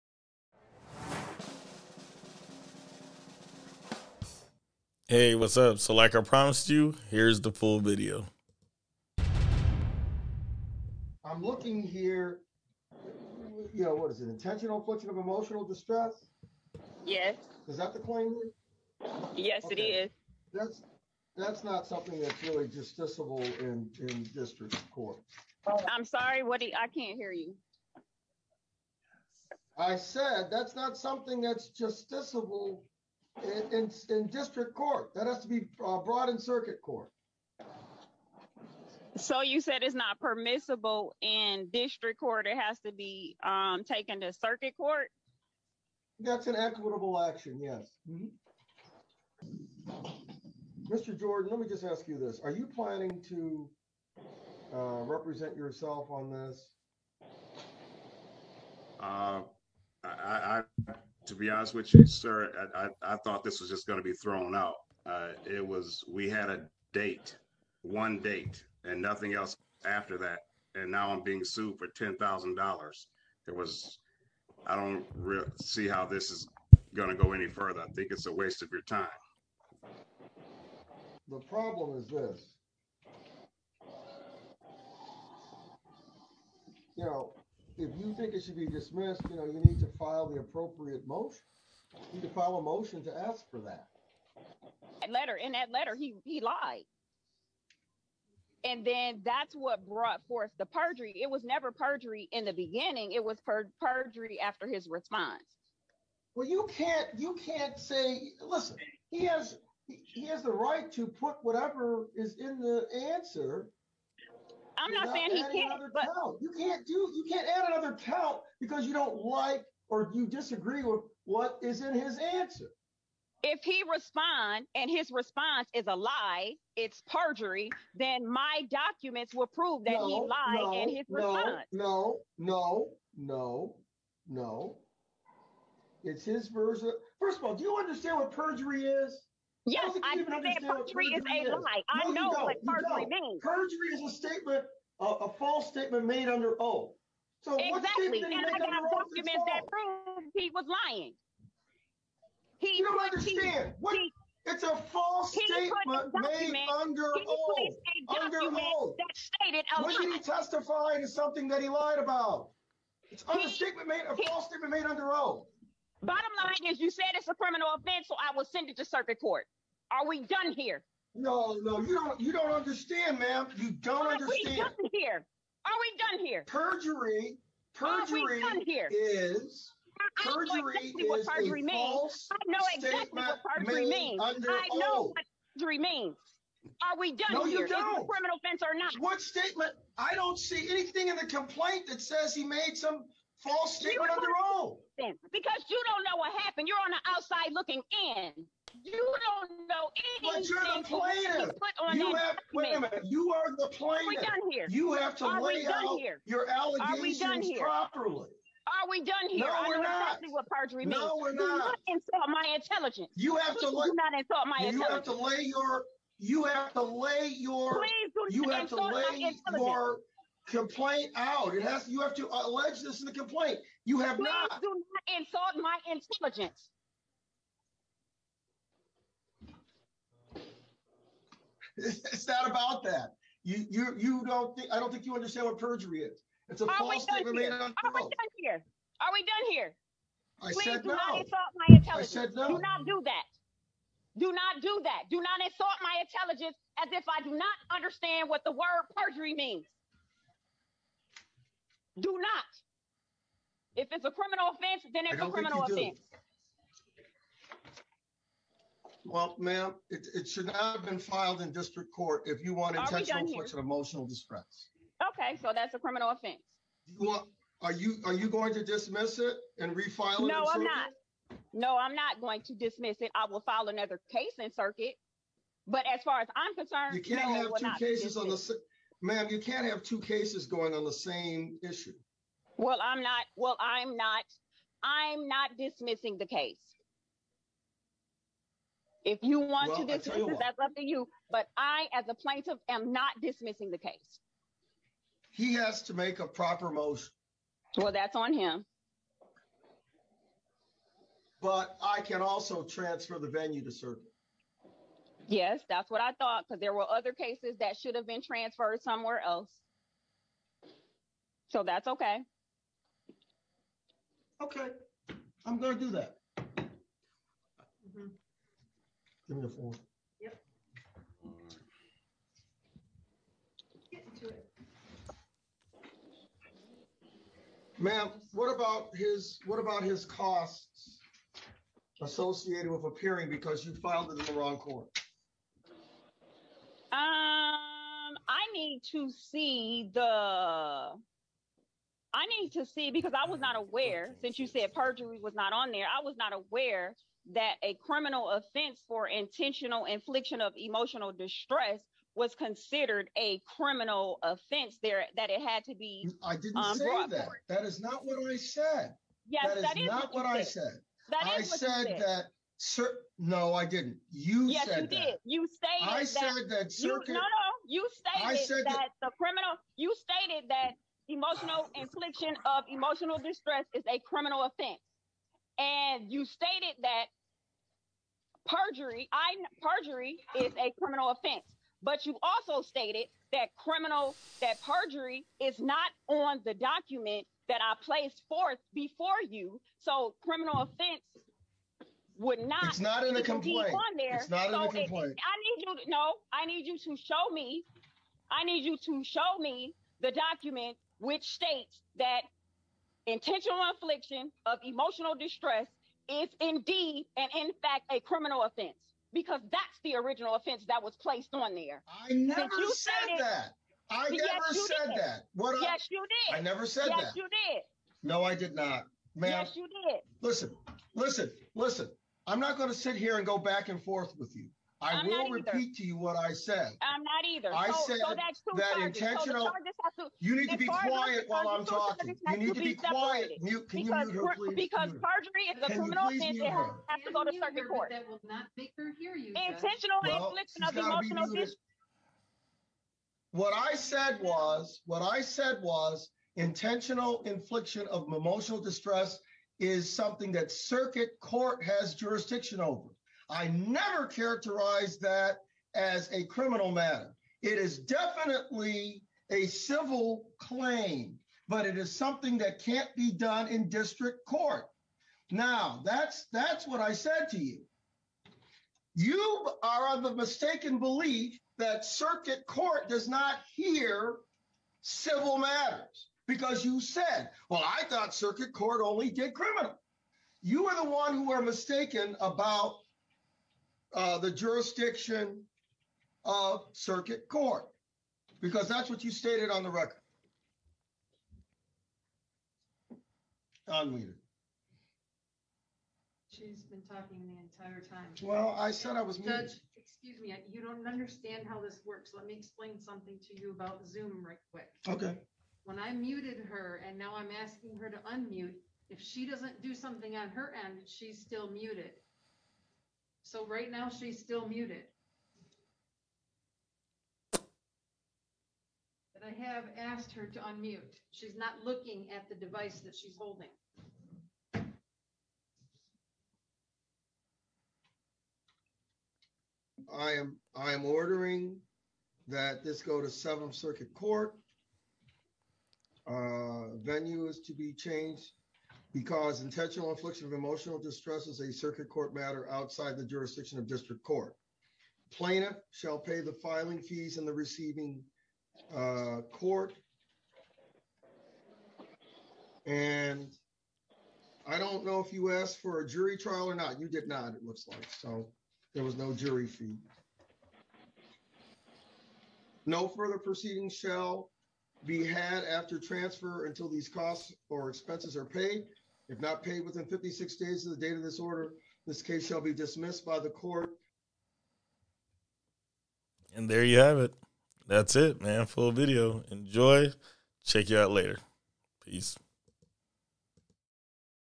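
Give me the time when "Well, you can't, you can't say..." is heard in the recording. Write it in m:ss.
1:46.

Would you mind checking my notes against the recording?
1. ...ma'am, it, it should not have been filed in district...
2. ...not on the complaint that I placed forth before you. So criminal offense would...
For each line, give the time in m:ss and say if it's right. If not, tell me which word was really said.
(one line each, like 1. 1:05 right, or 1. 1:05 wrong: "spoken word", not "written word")
1. 4:19 right
2. 6:25 wrong: "document", not "complaint".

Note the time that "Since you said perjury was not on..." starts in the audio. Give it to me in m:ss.
5:44.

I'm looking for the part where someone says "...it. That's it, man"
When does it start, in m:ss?
9:36.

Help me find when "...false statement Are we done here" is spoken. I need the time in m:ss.
3:56.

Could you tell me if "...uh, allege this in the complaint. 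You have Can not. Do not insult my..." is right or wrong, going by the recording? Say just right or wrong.
wrong.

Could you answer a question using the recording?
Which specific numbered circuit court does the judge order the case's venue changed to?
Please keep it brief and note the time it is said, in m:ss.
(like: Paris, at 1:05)
Seventh Circuit Court, at 8:53.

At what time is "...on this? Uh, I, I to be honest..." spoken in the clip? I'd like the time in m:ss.
0:56.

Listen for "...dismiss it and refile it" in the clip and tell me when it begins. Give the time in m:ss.
4:28.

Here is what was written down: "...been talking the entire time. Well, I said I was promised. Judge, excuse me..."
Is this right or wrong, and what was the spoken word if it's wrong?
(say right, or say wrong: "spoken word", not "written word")
wrong: "muted", not "promised".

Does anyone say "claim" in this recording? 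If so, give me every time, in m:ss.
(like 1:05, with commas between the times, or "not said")
0:17, 7:40.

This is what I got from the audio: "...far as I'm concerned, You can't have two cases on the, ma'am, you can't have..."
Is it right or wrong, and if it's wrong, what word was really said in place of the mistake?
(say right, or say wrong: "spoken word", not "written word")
right.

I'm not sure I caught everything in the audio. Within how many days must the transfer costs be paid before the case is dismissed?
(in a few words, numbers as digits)
56.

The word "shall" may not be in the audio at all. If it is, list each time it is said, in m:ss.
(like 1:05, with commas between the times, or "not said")
9:05, 9:23, 9:32.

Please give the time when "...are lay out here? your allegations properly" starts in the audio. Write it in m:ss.
3:25.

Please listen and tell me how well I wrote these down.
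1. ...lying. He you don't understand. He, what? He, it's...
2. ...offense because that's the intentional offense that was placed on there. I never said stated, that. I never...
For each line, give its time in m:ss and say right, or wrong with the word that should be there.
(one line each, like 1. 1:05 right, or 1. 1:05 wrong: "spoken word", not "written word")
1. 2:30 right
2. 6:48 wrong: "original", not "intentional".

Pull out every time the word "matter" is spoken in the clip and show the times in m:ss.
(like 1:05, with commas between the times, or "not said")
7:36, 7:55, 9:02.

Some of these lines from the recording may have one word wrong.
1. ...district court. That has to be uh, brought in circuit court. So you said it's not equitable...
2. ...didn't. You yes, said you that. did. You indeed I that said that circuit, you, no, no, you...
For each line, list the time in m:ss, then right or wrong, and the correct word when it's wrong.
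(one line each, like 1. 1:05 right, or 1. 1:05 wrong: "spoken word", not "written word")
1. 0:34 wrong: "permissible", not "equitable"
2. 6:03 wrong: "stated", not "indeed".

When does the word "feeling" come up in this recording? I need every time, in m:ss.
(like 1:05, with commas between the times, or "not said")
not said.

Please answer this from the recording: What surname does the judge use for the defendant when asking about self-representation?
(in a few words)
Jordan.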